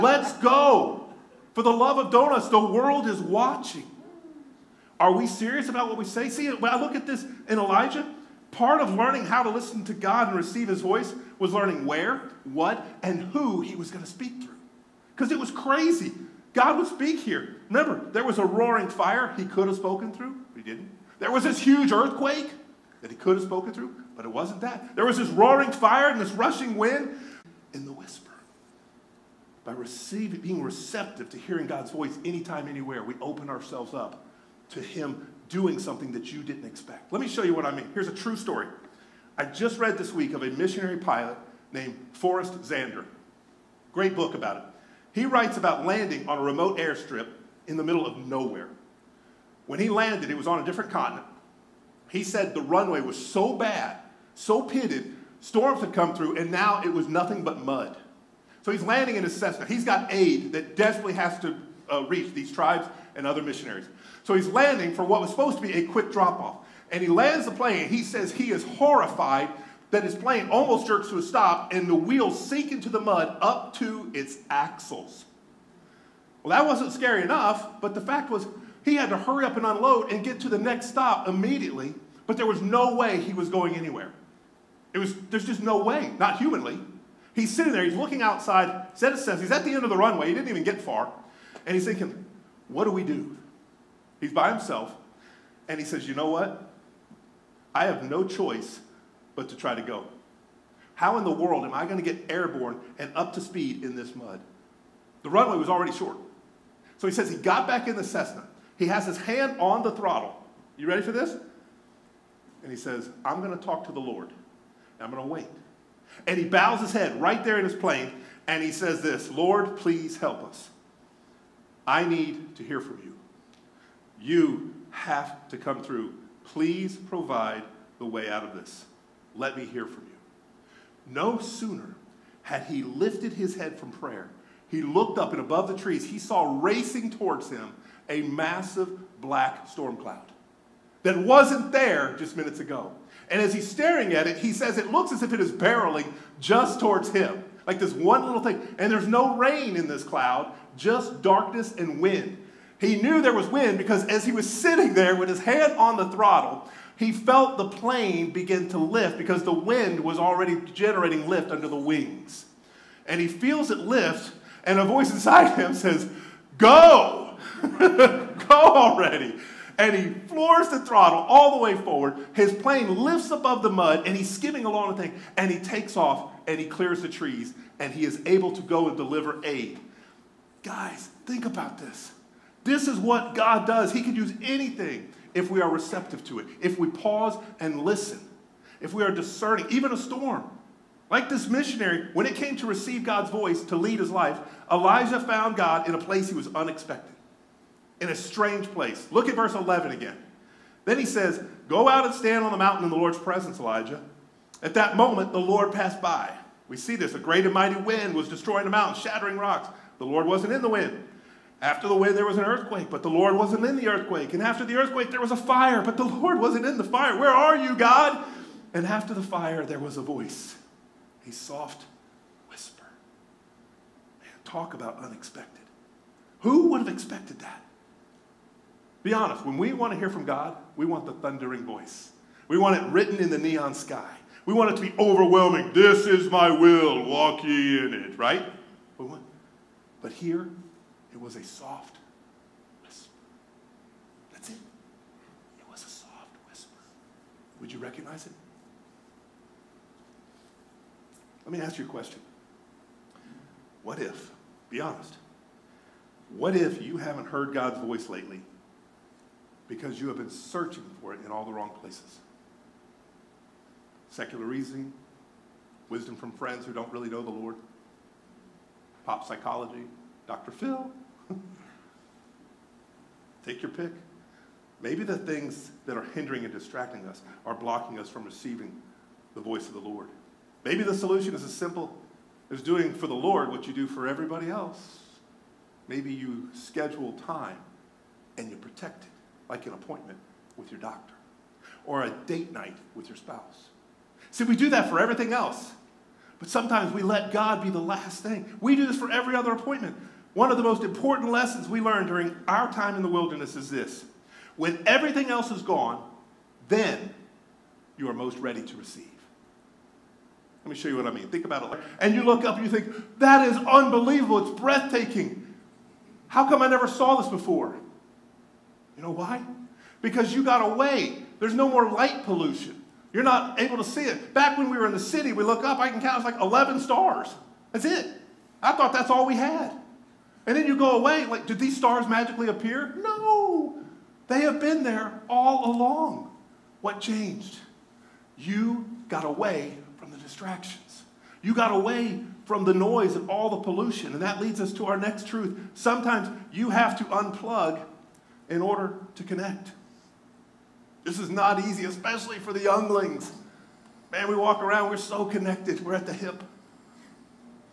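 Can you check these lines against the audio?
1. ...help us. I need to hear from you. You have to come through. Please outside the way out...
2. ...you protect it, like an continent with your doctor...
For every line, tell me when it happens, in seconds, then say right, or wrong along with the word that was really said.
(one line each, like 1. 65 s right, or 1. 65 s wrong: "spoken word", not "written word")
1. 120 s wrong: "provide", not "outside"
2. 288 s wrong: "appointment", not "continent".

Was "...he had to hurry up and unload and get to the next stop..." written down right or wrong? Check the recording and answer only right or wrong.
right.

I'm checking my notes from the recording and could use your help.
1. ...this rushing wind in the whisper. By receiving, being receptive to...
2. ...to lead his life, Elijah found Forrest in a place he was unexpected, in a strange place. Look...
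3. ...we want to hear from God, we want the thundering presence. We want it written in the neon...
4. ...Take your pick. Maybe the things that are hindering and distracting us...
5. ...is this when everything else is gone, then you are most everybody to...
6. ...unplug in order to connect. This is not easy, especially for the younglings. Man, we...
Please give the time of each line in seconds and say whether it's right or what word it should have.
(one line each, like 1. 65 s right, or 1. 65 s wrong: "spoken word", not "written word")
1. 26 s right
2. 193 s wrong: "God", not "Forrest"
3. 229 s wrong: "voice", not "presence"
4. 273 s right
5. 303 s wrong: "ready", not "everybody"
6. 347 s right.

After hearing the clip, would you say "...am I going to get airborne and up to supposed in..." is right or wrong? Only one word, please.
wrong.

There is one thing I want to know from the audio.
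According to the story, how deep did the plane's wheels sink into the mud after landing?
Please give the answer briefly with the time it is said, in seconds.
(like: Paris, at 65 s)
up to its axles, at 73 s.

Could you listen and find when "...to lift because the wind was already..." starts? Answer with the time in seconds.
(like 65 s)
158 s.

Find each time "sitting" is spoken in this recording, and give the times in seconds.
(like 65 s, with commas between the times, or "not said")
87 s, 154 s.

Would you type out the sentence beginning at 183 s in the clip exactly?
He can use anything if we are receptive to it, if we pause and listen, if we are discerning, even a storm.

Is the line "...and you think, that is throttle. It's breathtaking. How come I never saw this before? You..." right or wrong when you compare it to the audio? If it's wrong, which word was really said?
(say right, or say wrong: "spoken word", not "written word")
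wrong: "unbelievable", not "throttle".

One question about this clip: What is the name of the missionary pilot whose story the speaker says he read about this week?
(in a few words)
Forrest Zander.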